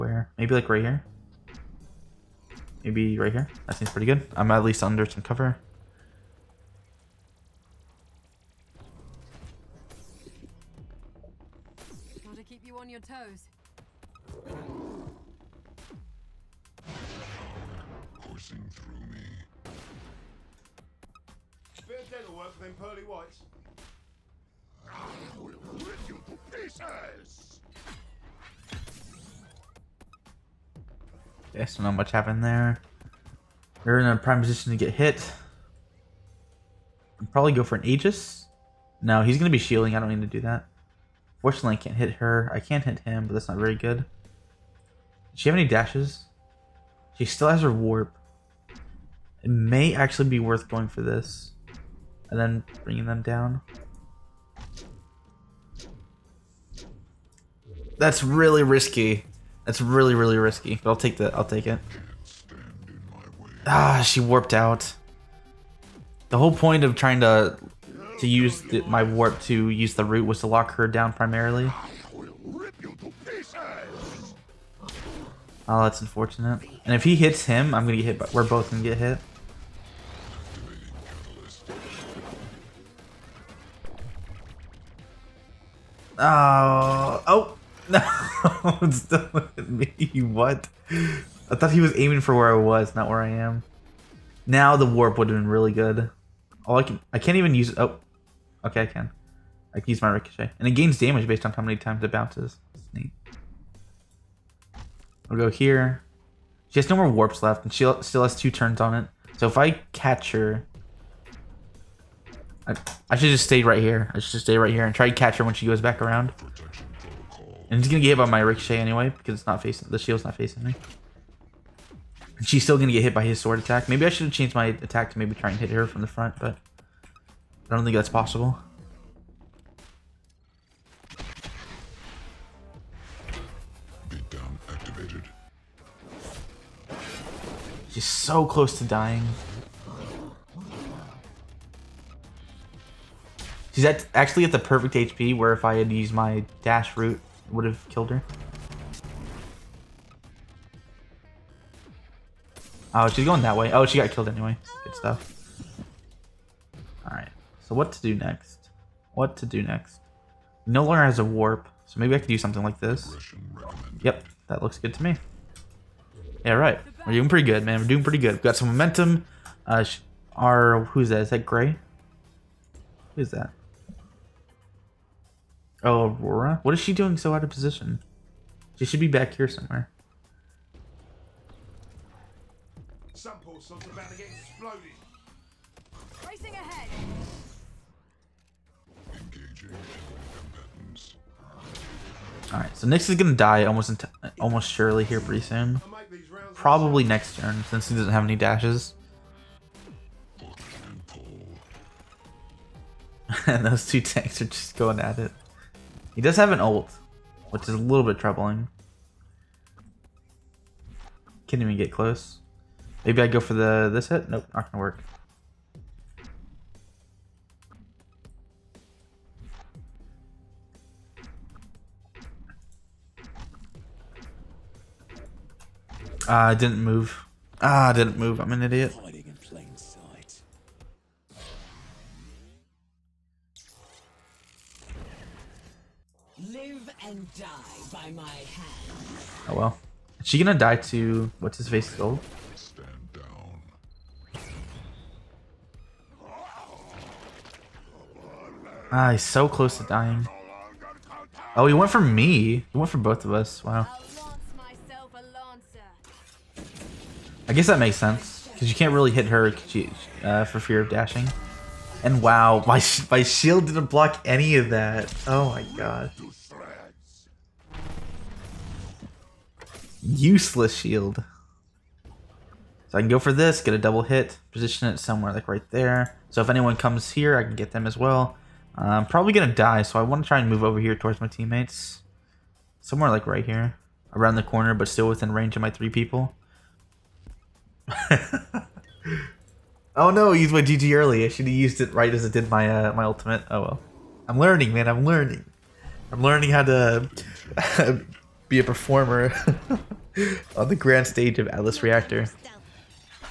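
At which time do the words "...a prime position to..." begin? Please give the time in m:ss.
0:34.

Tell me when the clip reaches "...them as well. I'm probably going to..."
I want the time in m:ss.
4:37.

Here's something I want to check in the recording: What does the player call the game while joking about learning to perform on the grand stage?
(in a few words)
Atlas Reactor.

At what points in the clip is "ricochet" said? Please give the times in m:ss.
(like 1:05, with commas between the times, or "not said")
1:40, 1:58.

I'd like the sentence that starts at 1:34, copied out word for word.
Now the warp would have been really good.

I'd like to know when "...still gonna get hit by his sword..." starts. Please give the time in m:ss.
2:02.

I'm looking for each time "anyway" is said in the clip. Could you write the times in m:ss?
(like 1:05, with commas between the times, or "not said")
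1:58, 2:34.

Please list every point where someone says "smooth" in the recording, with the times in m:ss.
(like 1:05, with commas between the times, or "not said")
not said.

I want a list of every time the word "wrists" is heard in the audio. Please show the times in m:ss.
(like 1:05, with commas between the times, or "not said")
not said.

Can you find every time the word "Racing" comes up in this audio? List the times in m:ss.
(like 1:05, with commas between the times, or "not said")
3:06.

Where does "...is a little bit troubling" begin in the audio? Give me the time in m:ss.
3:27.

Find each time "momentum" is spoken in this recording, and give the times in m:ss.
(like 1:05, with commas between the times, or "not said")
2:48.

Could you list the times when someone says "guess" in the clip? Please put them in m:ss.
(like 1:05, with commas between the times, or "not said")
4:17.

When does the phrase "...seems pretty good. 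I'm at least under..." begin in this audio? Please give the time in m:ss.
0:03.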